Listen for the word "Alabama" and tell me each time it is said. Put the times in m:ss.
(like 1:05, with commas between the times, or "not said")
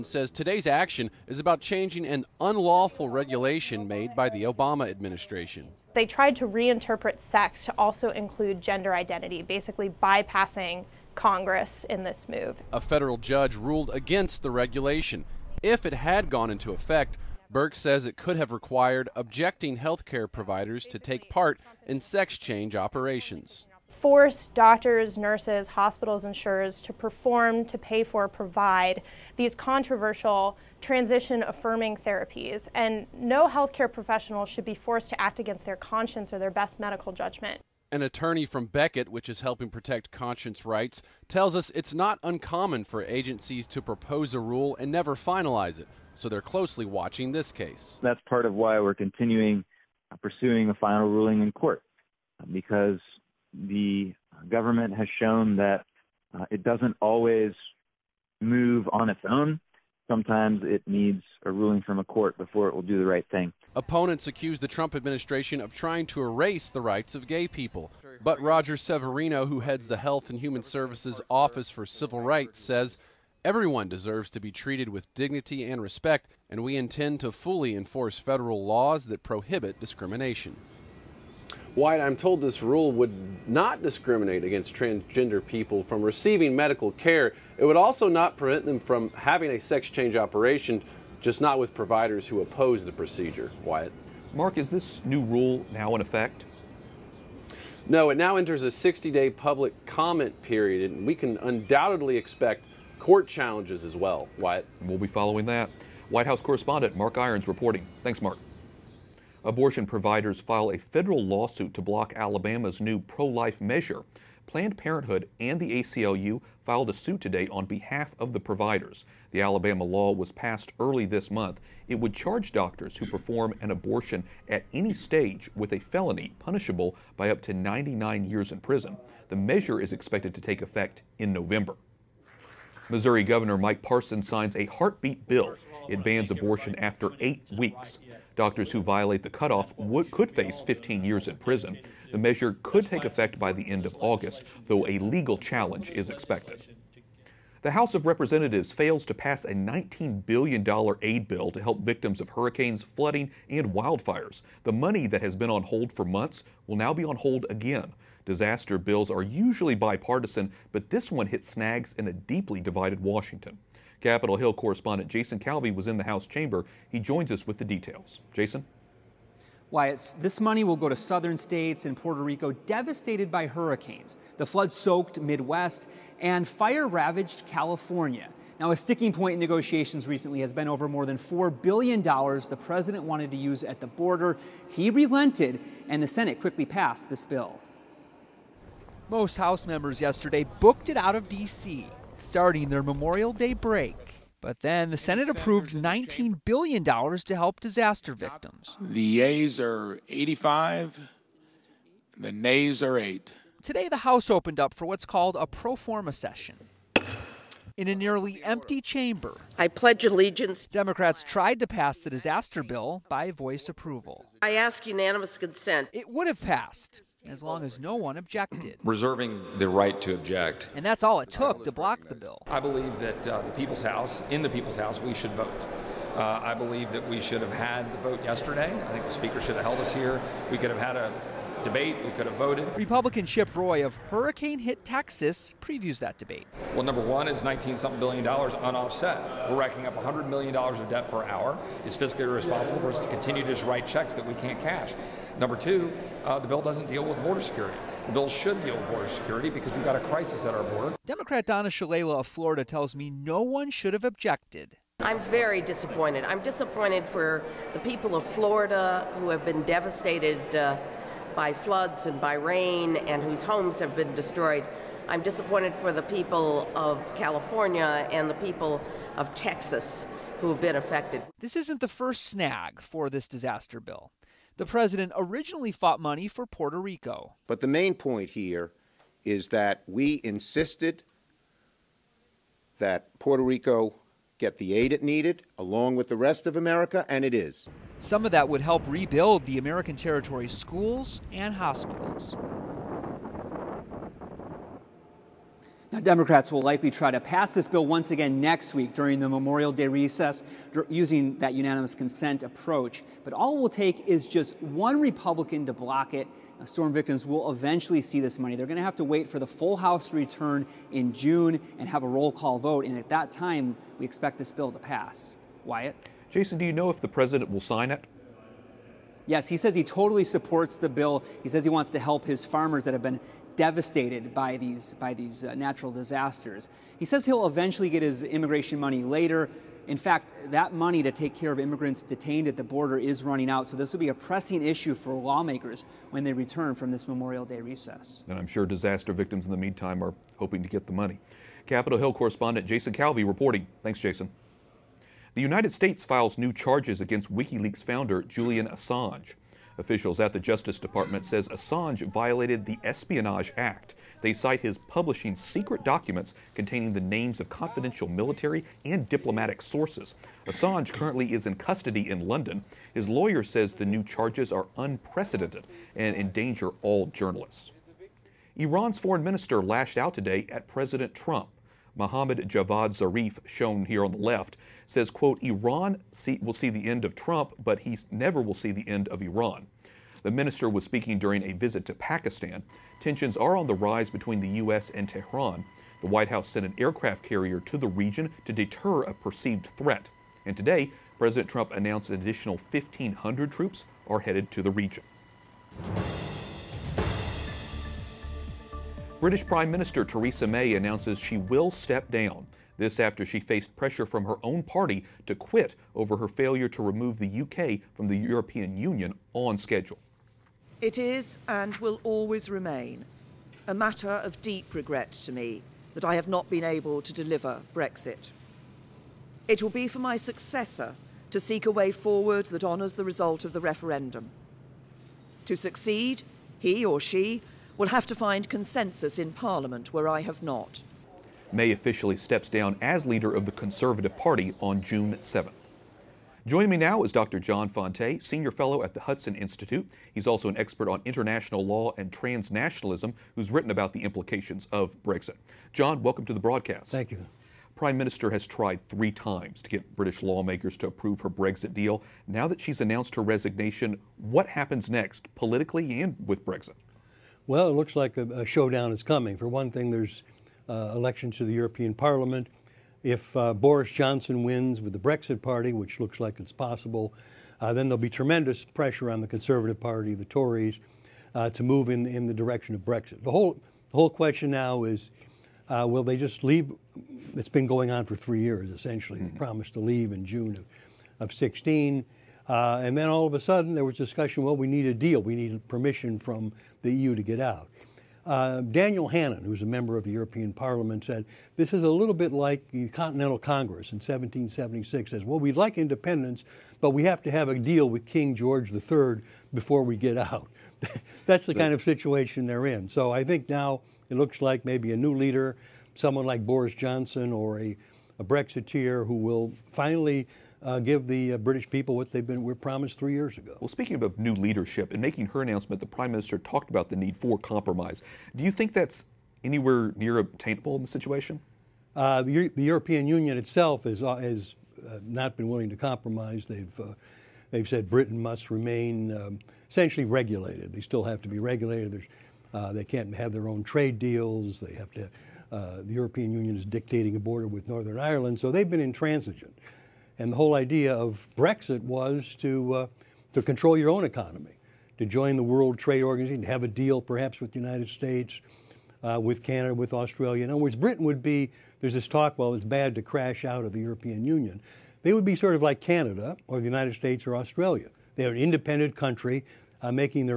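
1:52, 1:59.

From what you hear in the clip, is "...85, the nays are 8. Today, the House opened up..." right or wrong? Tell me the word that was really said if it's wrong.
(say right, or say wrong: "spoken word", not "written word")
right.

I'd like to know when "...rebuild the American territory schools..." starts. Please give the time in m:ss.
4:48.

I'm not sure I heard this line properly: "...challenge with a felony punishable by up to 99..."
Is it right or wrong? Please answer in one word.
wrong.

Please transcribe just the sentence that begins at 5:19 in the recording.
Yes, he says he totally supports the bill.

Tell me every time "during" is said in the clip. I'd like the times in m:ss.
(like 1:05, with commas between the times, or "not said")
4:58, 6:21.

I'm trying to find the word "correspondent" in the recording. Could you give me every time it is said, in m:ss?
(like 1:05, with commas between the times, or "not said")
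1:46, 2:44, 5:42.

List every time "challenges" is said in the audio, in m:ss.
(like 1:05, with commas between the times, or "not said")
1:43, 2:25.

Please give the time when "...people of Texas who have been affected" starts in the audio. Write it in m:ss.
4:28.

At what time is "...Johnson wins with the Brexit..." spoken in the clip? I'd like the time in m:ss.
7:43.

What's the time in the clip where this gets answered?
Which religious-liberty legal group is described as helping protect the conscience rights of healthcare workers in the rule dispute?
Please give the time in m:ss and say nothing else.
0:38.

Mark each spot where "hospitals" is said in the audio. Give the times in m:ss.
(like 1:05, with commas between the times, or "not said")
0:25, 4:51.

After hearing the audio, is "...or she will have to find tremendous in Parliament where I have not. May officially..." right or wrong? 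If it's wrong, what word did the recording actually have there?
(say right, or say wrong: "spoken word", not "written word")
wrong: "consensus", not "tremendous".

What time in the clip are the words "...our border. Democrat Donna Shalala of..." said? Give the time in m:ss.
4:10.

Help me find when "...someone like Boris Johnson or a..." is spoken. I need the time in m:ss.
8:25.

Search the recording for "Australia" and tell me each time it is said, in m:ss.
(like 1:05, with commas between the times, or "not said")
9:09, 9:17.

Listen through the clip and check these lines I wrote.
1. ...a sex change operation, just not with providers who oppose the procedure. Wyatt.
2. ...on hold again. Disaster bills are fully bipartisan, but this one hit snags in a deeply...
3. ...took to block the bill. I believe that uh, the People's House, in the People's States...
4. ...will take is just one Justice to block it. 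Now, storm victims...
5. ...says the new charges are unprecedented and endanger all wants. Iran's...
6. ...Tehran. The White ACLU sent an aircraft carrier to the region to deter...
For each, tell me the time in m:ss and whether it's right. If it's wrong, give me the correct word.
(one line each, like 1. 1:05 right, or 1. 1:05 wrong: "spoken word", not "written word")
1. 1:29 right
2. 2:37 wrong: "usually", not "fully"
3. 3:41 wrong: "House", not "States"
4. 5:03 wrong: "Republican", not "Justice"
5. 6:03 wrong: "journalists", not "wants"
6. 6:25 wrong: "House", not "ACLU".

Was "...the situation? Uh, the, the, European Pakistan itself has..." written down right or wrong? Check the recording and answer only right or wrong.
wrong.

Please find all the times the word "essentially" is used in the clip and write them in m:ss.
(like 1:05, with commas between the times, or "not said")
7:58, 8:49.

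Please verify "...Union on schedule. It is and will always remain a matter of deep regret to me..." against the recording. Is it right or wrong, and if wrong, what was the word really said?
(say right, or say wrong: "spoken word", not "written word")
right.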